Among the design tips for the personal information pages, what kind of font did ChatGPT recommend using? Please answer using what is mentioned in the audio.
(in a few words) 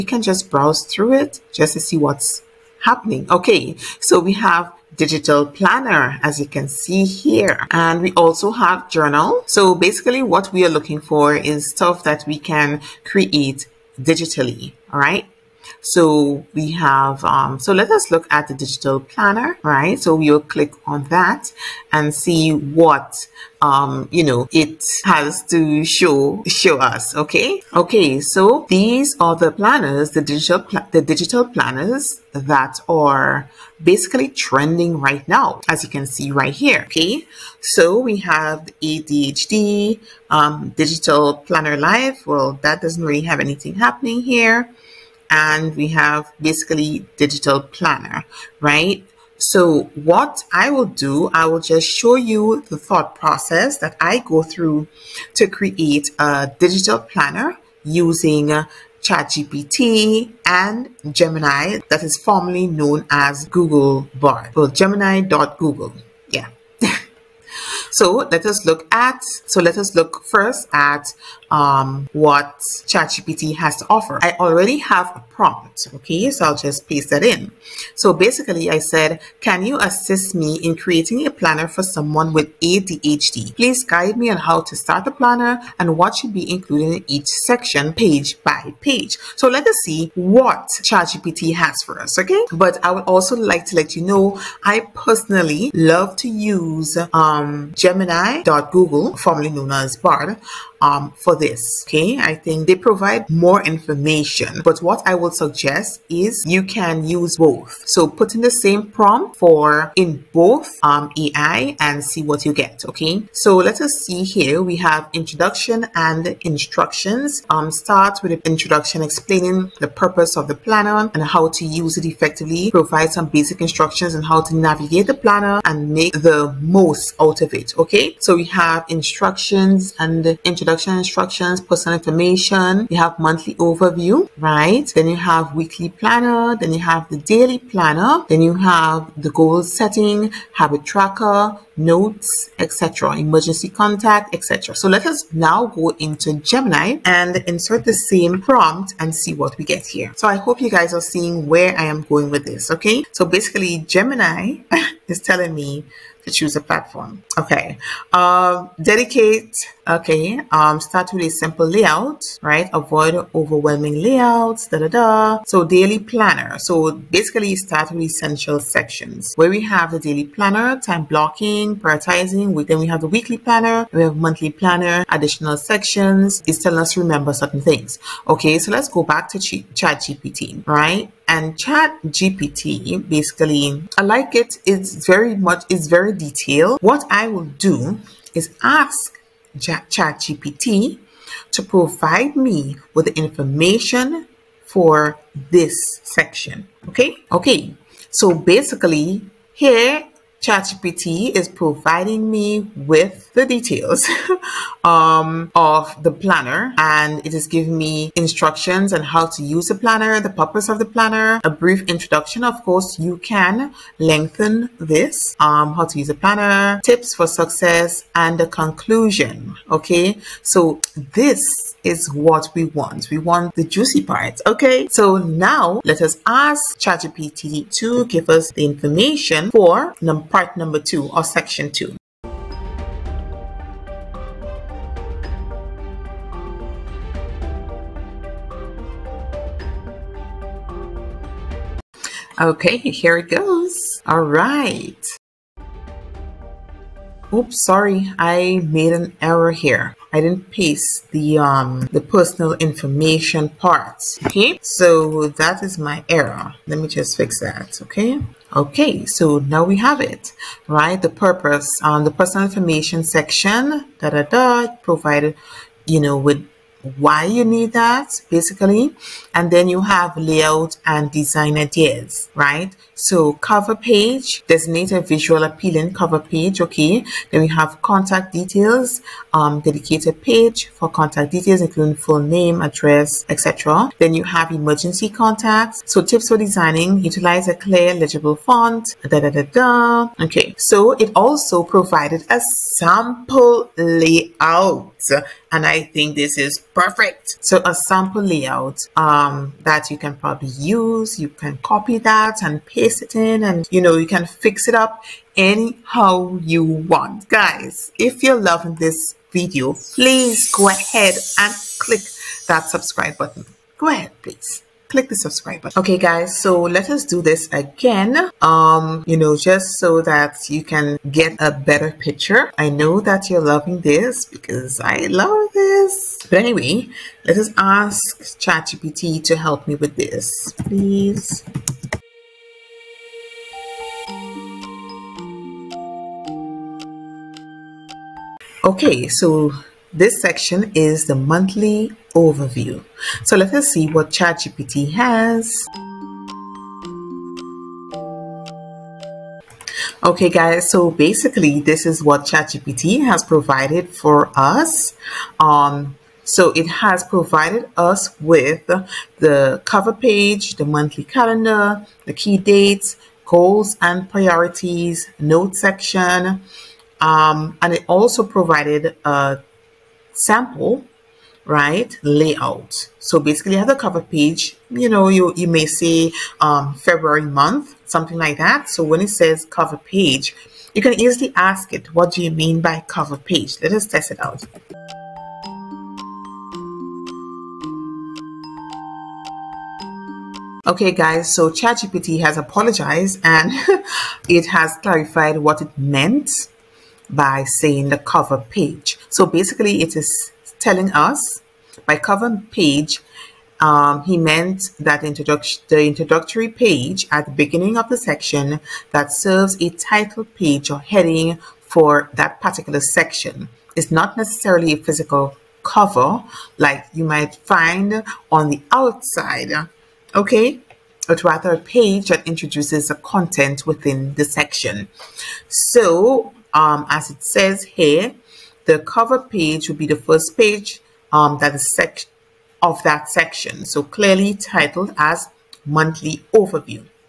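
A clear legible font.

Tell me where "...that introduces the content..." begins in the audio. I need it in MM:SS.
07:02.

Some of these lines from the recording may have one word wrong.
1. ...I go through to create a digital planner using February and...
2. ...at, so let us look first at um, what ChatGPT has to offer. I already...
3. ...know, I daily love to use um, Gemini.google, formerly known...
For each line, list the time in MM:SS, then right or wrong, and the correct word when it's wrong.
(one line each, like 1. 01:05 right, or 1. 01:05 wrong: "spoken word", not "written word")
1. 00:53 wrong: "ChatGPT", not "February"
2. 01:08 right
3. 01:34 wrong: "personally", not "daily".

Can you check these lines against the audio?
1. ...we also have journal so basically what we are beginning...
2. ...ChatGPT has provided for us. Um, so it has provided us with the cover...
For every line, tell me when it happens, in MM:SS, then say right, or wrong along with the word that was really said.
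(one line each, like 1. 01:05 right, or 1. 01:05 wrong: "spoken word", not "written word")
1. 00:08 wrong: "looking", not "beginning"
2. 05:52 right.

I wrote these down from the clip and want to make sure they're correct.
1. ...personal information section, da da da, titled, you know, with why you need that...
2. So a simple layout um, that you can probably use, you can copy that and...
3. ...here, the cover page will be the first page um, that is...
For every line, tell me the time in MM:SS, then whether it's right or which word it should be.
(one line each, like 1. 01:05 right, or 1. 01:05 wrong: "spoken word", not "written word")
1. 04:22 wrong: "provided", not "titled"
2. 04:57 wrong: "sample", not "simple"
3. 07:07 right.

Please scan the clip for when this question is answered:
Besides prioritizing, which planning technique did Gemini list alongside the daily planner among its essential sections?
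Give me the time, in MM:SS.
02:50.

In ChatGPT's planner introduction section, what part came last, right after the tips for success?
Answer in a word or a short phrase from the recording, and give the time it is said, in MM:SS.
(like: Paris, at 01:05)
A conclusion, at 03:38.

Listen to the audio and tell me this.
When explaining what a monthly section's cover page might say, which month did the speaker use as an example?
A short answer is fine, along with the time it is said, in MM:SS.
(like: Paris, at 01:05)
February, at 06:16.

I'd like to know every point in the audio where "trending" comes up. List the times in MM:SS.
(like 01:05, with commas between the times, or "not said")
00:34.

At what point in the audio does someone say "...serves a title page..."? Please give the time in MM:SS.
06:49.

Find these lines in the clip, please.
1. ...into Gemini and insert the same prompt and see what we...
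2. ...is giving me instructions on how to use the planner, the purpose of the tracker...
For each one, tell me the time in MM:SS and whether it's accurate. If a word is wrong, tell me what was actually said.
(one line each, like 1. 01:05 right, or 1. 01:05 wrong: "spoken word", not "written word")
1. 02:26 right
2. 03:27 wrong: "planner", not "tracker".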